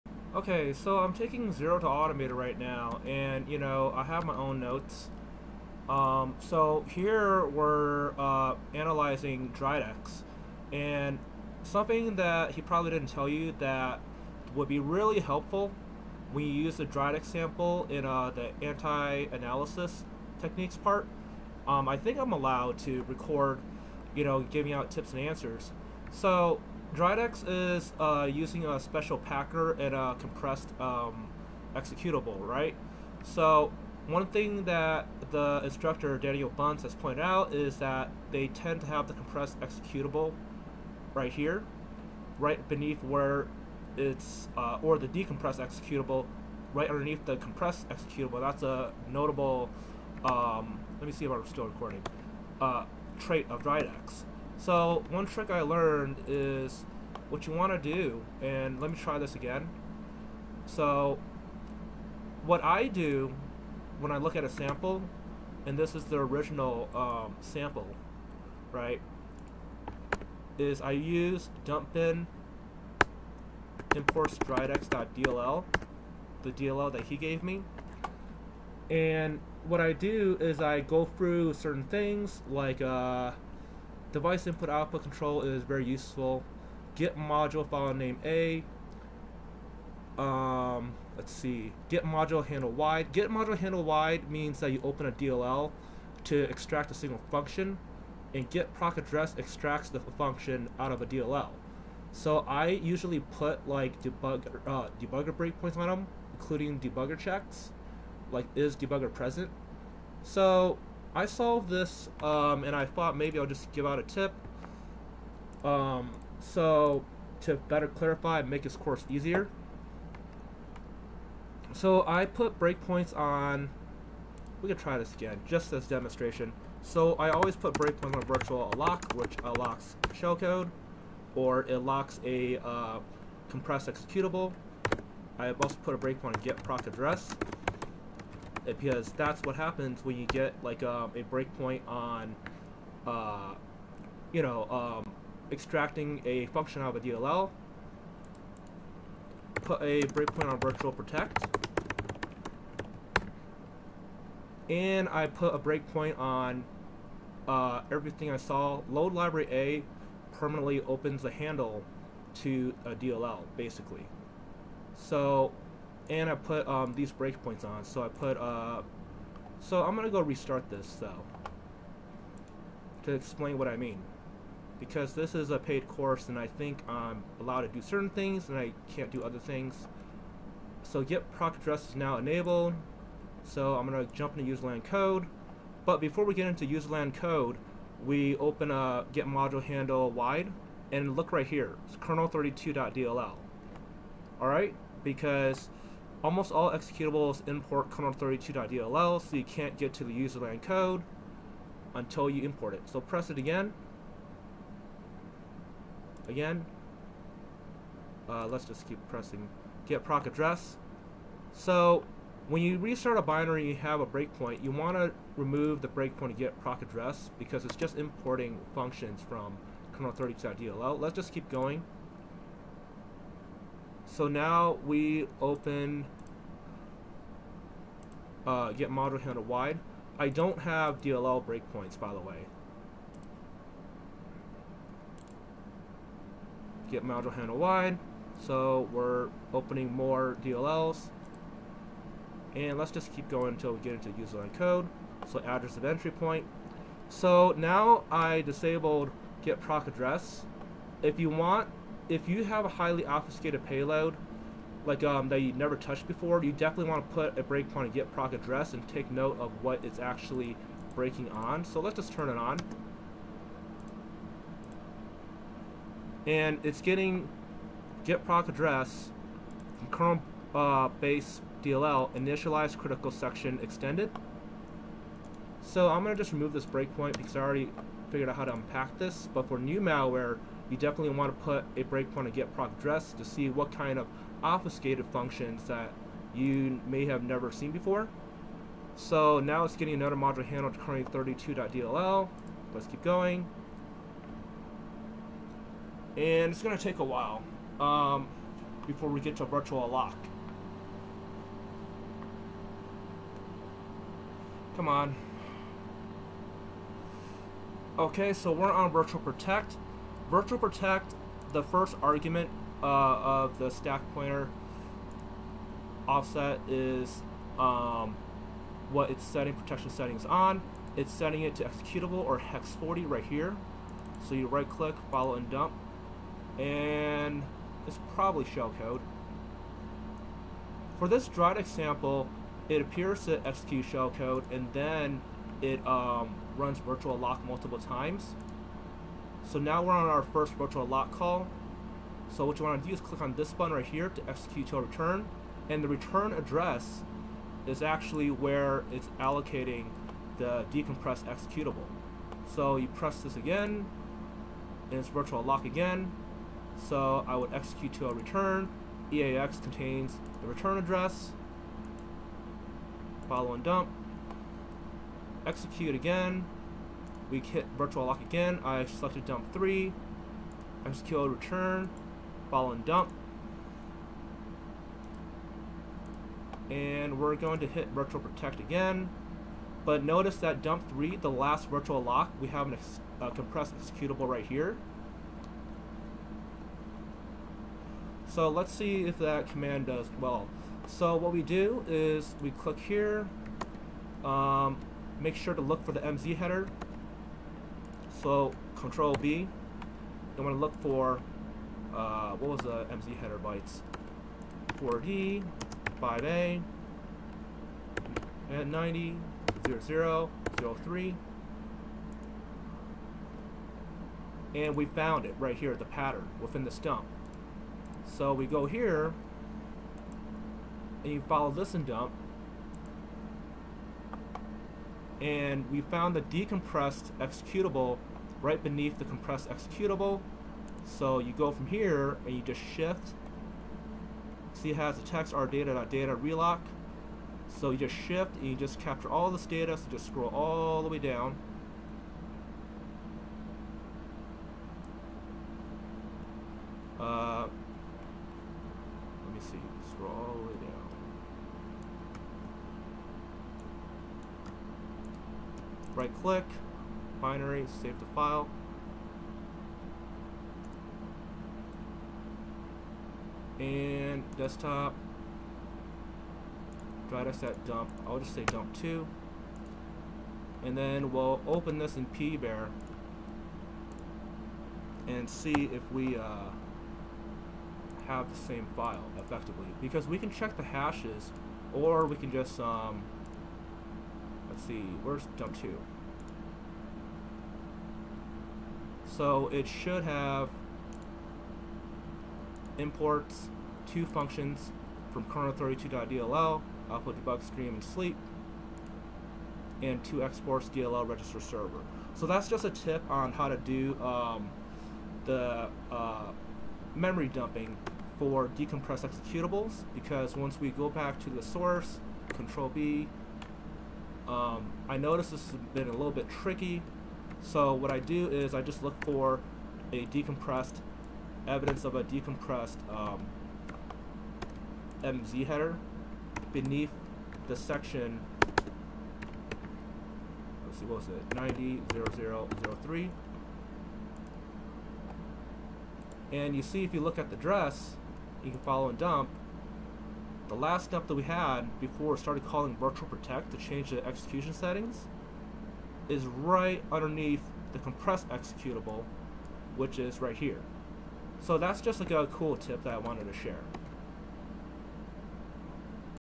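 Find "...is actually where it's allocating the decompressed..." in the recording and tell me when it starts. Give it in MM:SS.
05:47.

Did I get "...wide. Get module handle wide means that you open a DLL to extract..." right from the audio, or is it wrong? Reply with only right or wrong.
right.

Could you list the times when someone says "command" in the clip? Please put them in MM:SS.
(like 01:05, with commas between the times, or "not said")
06:29.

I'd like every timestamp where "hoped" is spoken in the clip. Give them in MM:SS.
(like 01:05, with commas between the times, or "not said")
not said.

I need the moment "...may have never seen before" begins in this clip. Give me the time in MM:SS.
04:46.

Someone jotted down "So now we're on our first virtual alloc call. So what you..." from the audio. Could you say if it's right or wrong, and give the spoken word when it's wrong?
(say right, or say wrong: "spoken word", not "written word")
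right.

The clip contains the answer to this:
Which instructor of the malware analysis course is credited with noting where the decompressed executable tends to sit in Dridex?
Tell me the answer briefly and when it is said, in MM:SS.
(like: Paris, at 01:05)
Daniel Bunce, at 00:36.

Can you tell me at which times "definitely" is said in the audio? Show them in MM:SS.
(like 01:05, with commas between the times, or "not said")
04:16, 04:40.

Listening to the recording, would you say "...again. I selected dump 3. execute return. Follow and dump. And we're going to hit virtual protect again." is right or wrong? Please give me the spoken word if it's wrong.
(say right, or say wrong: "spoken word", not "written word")
right.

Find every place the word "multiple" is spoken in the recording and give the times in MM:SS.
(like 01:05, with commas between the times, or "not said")
05:37.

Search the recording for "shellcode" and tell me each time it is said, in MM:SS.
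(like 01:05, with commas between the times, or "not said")
02:10, 05:28, 05:33.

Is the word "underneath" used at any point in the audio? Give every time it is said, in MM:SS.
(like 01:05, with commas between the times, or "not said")
00:46, 09:06.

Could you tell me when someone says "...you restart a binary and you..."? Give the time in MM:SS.
03:32.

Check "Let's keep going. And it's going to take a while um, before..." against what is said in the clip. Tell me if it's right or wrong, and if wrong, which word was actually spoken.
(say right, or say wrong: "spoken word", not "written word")
right.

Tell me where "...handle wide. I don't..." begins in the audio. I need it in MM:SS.
03:49.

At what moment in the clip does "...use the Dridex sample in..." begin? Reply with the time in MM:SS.
00:16.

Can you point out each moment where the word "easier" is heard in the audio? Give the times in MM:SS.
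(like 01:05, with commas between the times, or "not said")
01:59.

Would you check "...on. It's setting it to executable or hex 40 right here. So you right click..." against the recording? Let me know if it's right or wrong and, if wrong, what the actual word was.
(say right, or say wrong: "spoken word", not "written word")
right.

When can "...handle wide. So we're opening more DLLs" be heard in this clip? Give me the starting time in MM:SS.
03:57.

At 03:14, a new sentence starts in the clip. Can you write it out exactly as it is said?
All right, because Almost all executables import kernel32.dll, so you can't get to the userland code until you import it.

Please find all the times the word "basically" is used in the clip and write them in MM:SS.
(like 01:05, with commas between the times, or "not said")
02:43.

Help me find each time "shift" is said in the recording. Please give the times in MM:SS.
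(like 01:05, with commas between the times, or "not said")
07:12, 07:17.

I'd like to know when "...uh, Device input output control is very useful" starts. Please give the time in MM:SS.
01:22.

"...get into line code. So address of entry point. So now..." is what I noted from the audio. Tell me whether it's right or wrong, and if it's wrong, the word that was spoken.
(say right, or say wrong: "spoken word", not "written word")
right.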